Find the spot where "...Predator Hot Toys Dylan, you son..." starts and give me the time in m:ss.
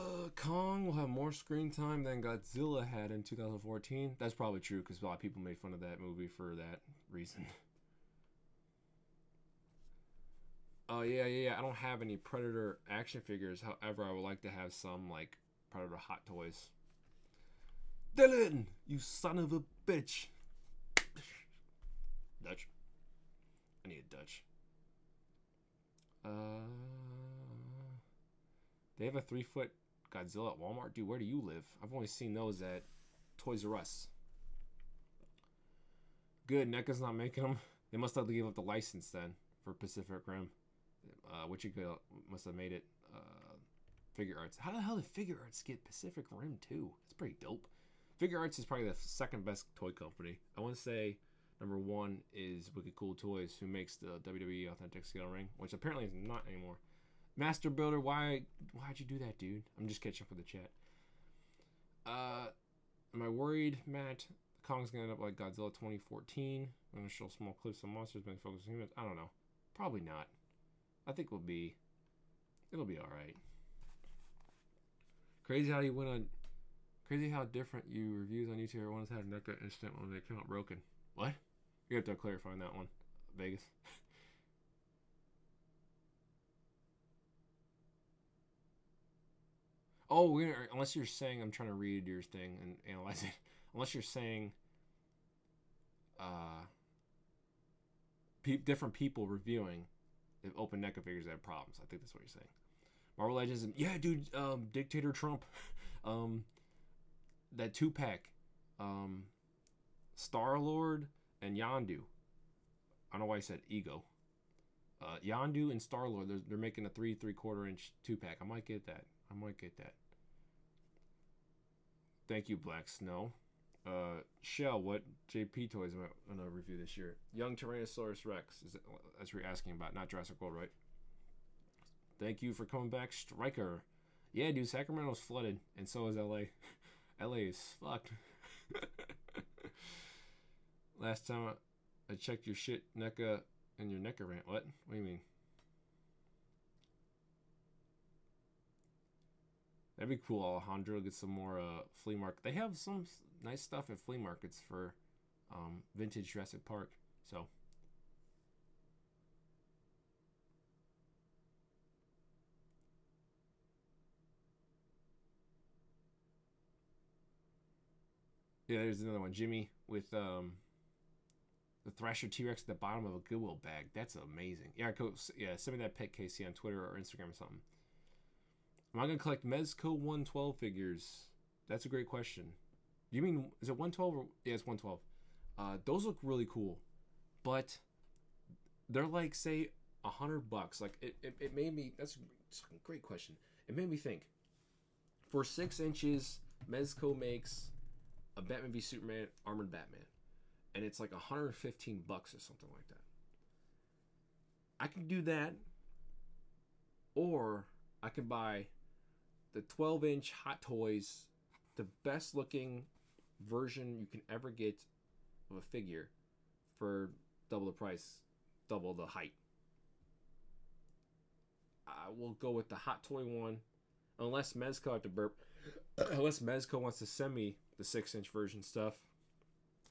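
0:15.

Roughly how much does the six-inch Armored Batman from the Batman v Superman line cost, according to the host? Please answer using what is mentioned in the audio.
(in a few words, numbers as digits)
$115.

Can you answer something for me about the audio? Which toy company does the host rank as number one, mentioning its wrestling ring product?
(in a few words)
Wicked Cool Toys.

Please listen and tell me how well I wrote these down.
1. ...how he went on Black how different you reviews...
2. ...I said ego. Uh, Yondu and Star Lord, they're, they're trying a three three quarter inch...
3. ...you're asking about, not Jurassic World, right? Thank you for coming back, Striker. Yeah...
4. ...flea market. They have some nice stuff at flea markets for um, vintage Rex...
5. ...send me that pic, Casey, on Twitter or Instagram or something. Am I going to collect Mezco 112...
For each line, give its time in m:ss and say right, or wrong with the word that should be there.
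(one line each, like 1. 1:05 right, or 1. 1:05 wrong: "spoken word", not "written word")
1. 1:15 wrong: "Crazy", not "Black"
2. 1:53 wrong: "making", not "trying"
3. 2:09 right
4. 2:32 wrong: "Jurassic", not "Rex"
5. 2:55 right.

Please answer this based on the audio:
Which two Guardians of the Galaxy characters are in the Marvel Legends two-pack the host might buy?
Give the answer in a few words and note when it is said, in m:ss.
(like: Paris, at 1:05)
Star Lord and Yondu, at 1:50.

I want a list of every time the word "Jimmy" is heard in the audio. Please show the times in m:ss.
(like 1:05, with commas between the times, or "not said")
2:49.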